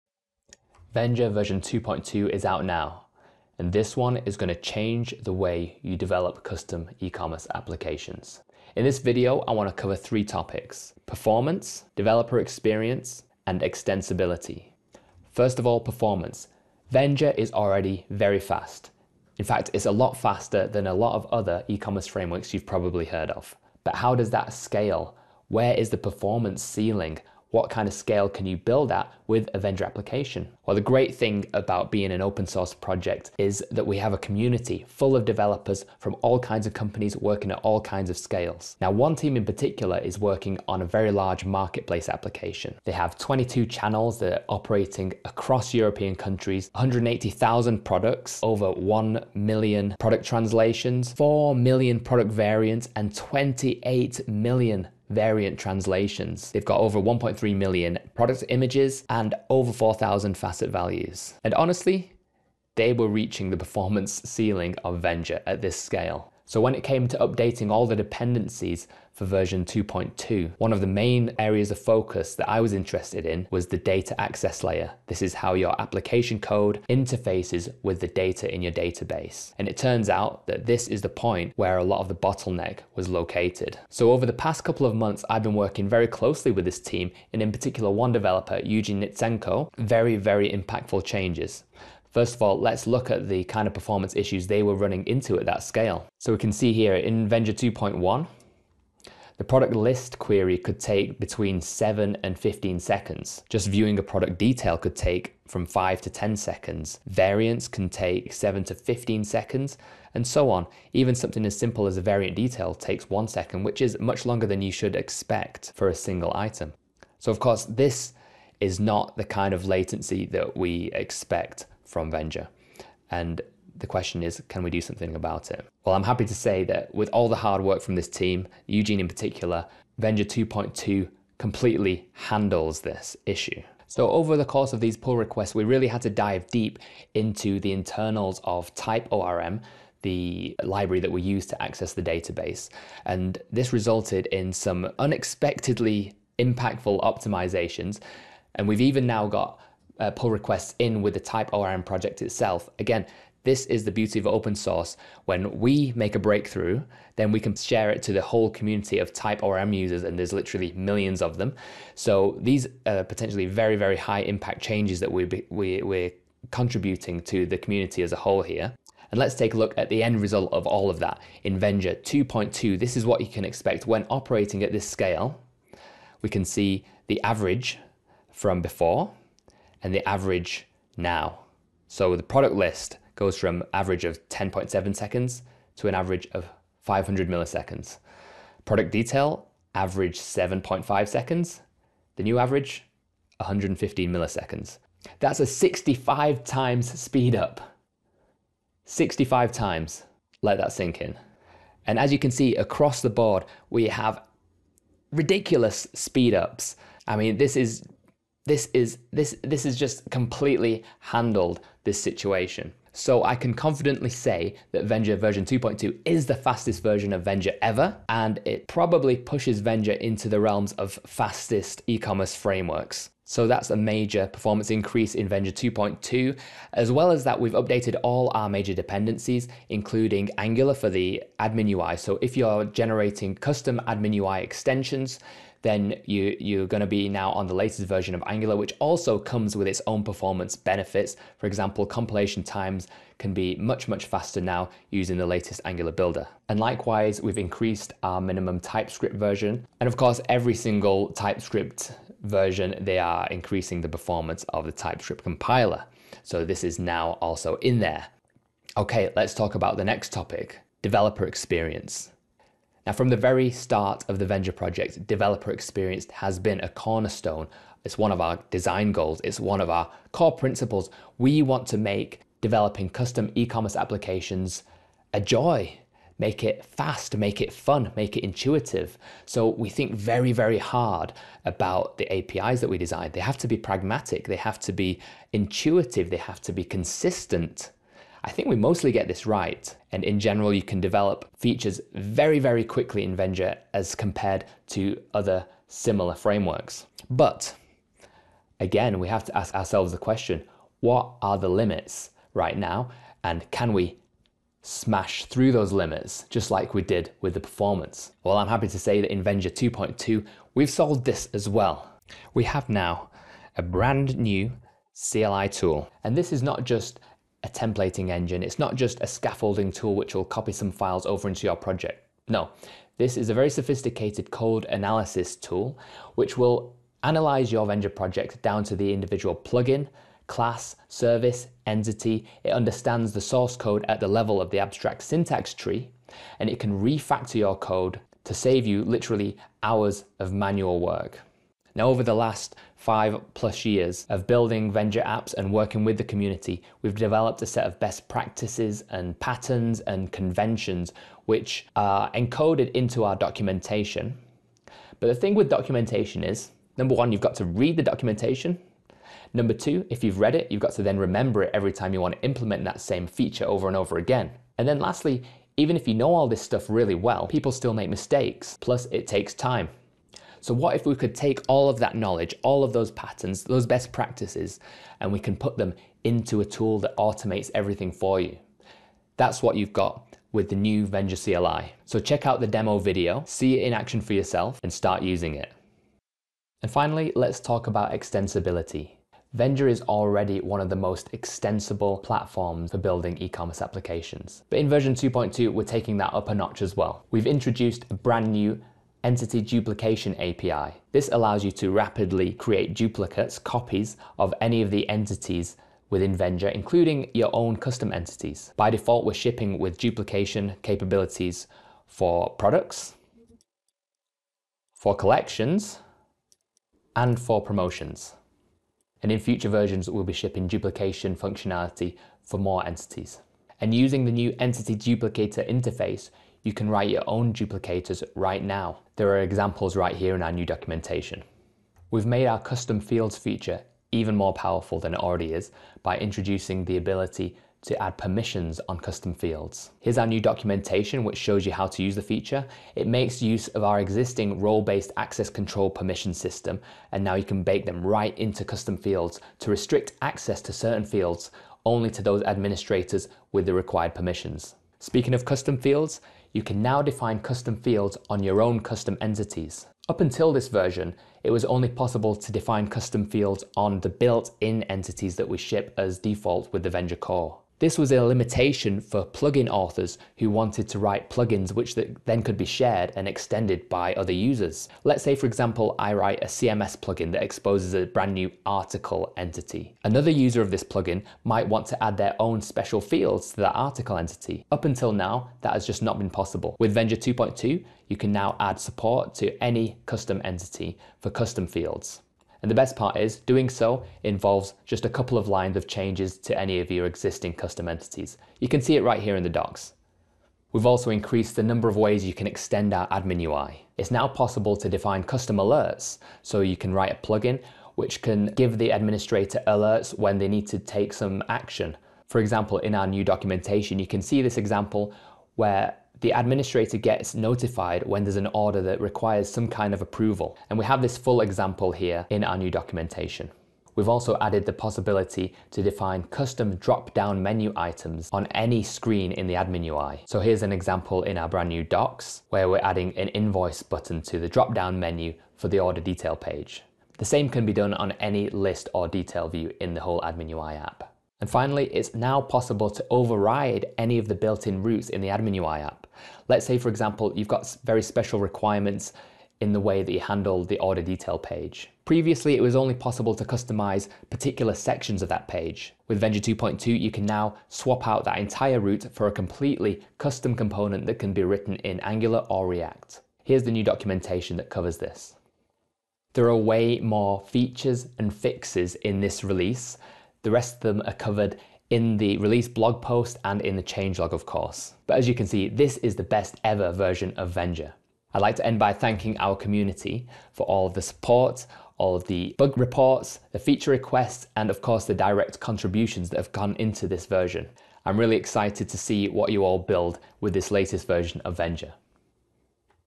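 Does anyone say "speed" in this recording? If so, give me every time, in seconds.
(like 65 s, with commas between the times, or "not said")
196 s, 205 s.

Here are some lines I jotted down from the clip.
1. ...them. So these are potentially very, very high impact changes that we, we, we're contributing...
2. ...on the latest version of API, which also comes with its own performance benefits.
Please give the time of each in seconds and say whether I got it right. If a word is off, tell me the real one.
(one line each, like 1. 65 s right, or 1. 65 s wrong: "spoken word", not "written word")
1. 161 s right
2. 237 s wrong: "Angular", not "API".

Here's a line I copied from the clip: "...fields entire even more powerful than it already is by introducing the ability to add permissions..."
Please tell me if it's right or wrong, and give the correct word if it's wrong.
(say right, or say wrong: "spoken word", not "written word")
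wrong: "feature", not "entire".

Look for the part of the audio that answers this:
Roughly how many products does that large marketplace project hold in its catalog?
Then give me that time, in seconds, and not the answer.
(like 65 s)
46 s.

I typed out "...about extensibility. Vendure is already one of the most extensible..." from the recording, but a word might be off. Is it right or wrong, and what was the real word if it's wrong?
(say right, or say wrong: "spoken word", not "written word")
right.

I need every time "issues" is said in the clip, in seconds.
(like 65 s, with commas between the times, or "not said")
94 s, 133 s.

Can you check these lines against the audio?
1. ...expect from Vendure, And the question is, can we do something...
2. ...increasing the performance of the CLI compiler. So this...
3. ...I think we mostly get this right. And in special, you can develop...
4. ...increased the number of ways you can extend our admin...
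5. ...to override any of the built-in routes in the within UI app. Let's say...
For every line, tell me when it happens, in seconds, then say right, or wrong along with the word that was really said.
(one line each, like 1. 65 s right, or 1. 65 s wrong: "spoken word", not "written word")
1. 120 s right
2. 253 s wrong: "TypeScript", not "CLI"
3. 288 s wrong: "general", not "special"
4. 500 s right
5. 542 s wrong: "admin", not "within".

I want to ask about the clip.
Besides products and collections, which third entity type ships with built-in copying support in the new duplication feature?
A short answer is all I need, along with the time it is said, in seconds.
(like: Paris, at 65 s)
Promotions, at 417 s.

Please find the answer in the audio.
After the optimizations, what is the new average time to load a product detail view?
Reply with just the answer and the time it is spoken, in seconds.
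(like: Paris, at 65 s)
115 milliseconds, at 193 s.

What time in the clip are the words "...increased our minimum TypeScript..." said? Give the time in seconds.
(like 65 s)
247 s.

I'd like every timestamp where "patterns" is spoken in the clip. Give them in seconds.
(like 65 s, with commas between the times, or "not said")
349 s, 372 s.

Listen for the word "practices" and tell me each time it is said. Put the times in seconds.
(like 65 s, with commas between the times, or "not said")
348 s, 373 s.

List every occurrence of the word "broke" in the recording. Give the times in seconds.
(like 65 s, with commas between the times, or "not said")
not said.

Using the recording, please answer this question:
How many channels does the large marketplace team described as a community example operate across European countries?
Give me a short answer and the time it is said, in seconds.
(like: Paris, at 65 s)
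22, at 43 s.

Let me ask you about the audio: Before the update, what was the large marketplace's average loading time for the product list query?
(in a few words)
10.7 seconds.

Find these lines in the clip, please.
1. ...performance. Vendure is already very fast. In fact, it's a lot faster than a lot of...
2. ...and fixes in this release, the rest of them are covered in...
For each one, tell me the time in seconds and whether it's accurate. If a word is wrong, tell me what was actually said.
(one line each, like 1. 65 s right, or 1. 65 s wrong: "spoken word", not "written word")
1. 15 s right
2. 567 s right.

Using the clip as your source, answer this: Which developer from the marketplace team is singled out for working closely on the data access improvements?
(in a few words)
Eugene Nitsenko.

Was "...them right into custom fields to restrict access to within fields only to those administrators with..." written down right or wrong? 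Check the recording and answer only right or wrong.
wrong.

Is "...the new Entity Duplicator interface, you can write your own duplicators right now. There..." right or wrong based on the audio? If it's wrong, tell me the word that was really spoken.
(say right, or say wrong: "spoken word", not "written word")
right.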